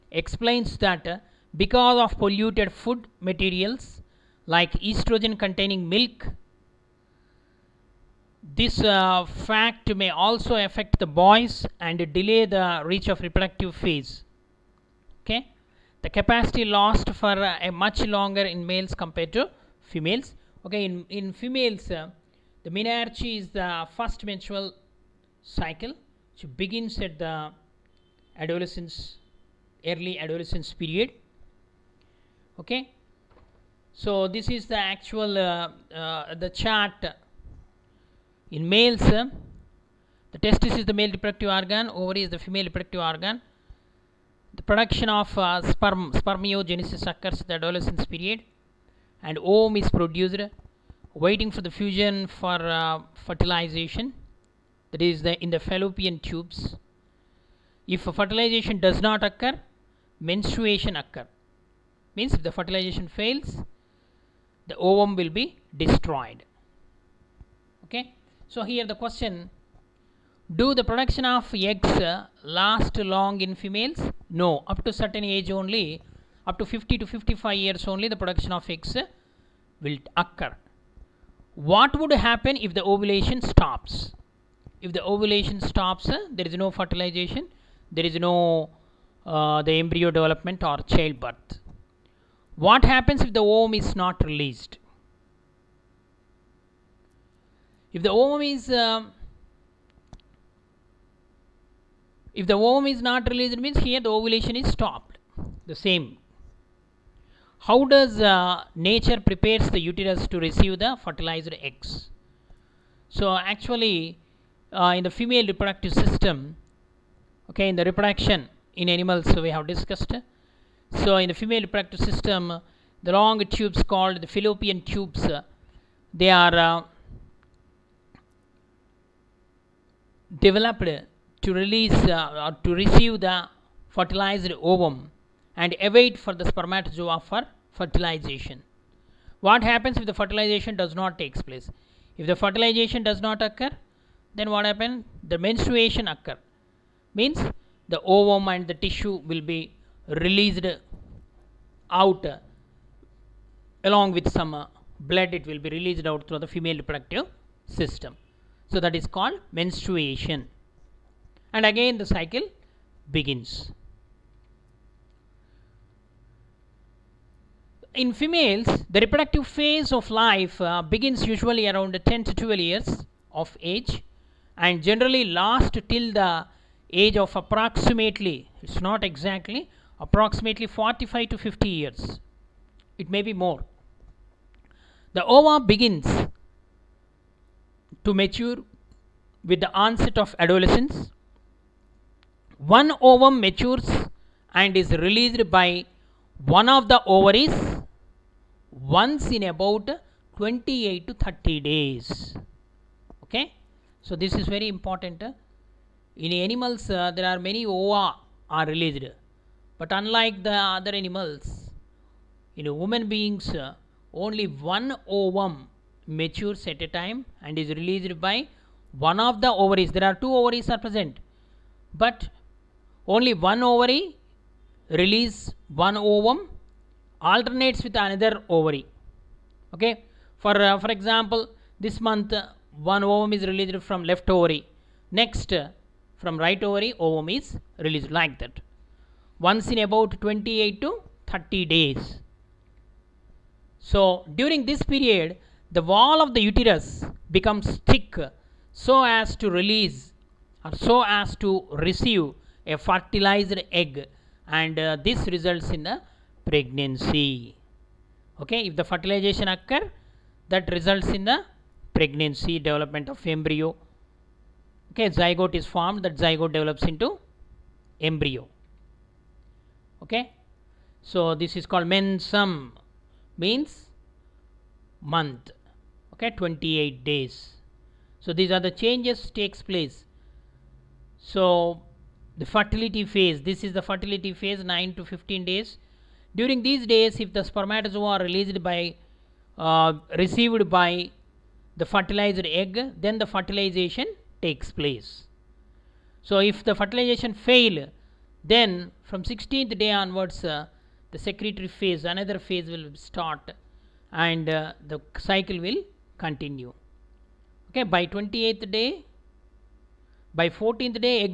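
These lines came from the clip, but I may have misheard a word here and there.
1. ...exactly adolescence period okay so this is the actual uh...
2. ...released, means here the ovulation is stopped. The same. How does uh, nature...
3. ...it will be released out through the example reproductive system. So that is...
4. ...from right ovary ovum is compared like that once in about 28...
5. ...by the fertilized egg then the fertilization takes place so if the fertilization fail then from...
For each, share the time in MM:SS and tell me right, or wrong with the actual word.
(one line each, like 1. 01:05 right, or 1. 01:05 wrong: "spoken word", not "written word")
1. 00:29 wrong: "early", not "exactly"
2. 01:43 right
3. 02:35 wrong: "female", not "example"
4. 03:56 wrong: "released", not "compared"
5. 04:50 right.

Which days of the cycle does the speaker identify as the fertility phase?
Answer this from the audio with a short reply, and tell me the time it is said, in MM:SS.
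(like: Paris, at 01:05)
9 to 15 days, at 04:44.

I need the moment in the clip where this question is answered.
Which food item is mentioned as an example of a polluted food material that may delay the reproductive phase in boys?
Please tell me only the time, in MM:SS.
00:04.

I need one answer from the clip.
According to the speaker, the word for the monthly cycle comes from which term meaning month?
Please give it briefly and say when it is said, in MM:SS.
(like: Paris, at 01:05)
mensum, at 04:31.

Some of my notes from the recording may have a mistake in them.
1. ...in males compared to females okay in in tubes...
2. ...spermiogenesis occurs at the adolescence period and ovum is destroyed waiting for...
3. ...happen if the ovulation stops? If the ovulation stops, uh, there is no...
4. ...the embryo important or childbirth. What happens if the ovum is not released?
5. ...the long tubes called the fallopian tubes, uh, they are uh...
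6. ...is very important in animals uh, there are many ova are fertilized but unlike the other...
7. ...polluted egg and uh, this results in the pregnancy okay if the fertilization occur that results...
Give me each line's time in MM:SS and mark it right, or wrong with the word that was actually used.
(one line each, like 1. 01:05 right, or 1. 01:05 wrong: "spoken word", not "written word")
1. 00:18 wrong: "females", not "tubes"
2. 00:46 wrong: "produced", not "destroyed"
3. 01:22 right
4. 01:29 wrong: "development", not "important"
5. 02:03 right
6. 03:24 wrong: "released", not "fertilized"
7. 04:12 wrong: "fertilized", not "polluted".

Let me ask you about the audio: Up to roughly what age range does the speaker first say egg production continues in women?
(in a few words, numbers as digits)
50 to 55 years.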